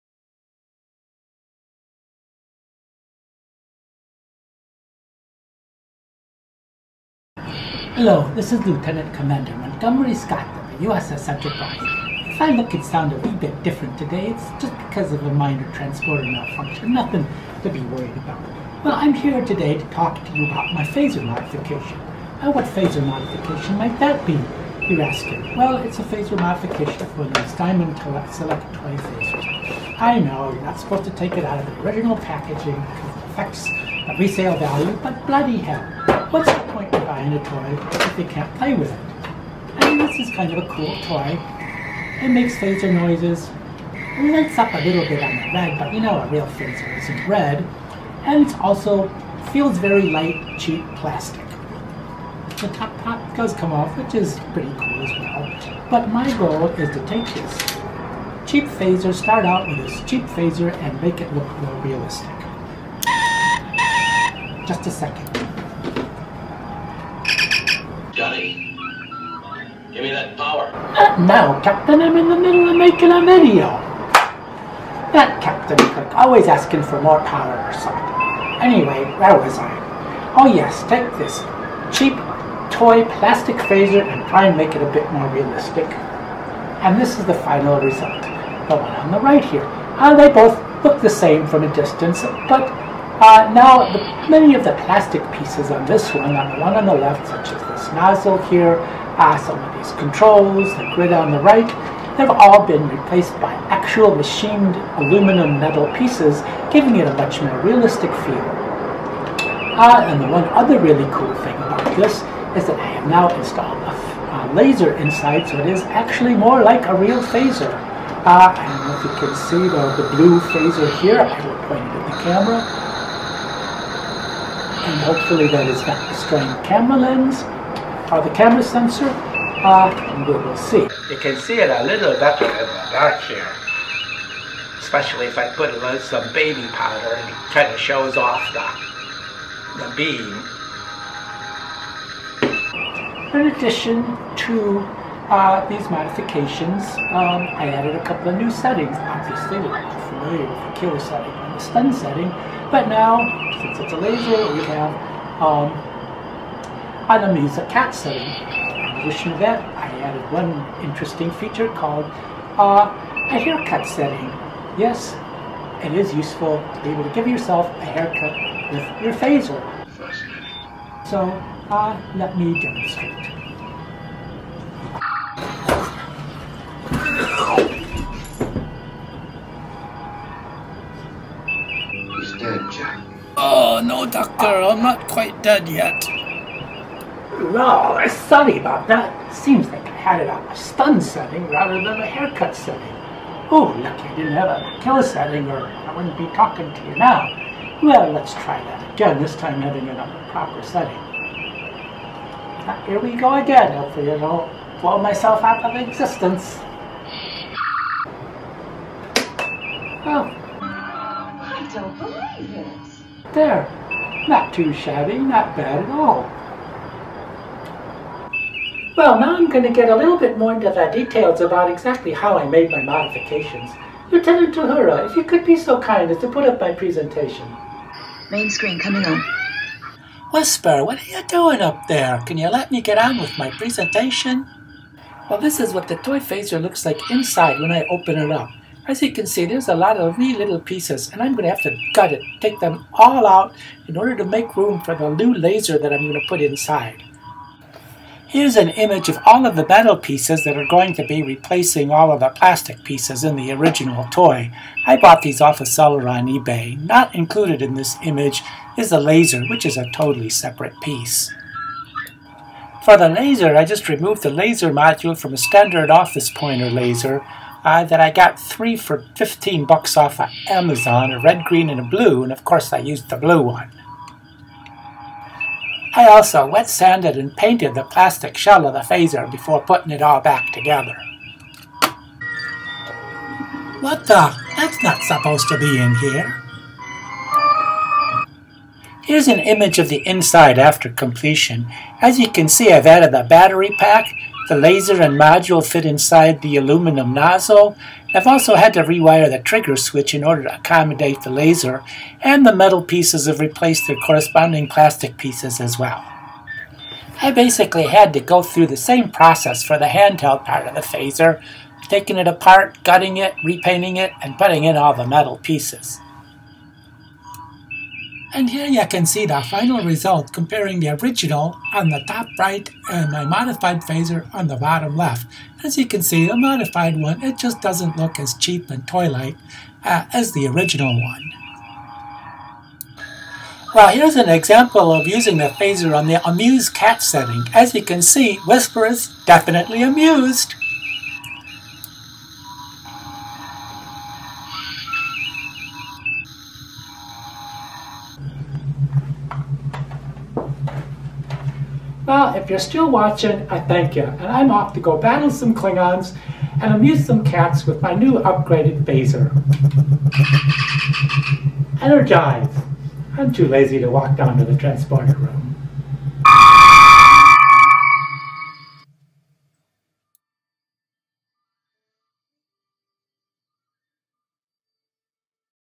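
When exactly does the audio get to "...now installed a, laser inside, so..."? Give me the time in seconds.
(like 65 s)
113 s.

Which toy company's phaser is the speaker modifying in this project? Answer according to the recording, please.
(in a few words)
Diamond Select.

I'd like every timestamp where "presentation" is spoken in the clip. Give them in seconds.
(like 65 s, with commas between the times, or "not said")
226 s, 233 s.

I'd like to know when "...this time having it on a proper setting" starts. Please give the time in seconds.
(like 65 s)
199 s.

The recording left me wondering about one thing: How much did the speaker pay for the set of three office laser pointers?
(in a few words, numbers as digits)
15 dollars.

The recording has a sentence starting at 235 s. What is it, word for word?
Well, this is what the toy phaser looks like inside when I open it up.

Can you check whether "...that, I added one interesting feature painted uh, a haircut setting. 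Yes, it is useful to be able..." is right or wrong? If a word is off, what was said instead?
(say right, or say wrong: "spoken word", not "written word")
wrong: "called", not "painted".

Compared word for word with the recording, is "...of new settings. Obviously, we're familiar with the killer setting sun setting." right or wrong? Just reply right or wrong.
right.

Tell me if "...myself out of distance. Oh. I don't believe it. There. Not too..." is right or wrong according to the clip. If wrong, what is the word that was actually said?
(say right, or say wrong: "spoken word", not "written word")
wrong: "existence", not "distance".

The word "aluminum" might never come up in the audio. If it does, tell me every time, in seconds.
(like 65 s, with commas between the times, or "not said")
104 s, 296 s.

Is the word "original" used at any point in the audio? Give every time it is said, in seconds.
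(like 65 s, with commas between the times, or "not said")
31 s, 253 s, 321 s, 330 s.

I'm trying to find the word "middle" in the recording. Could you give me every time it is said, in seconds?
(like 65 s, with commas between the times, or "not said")
72 s.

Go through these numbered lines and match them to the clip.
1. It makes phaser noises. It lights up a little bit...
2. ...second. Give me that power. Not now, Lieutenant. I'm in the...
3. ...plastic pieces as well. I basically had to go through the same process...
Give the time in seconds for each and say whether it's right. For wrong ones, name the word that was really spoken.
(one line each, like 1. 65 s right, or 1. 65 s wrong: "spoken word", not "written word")
1. 42 s right
2. 64 s wrong: "Captain", not "Lieutenant"
3. 304 s right.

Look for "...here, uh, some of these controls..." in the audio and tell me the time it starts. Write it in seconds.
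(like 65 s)
98 s.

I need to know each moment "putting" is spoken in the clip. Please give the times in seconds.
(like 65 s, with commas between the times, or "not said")
279 s, 314 s.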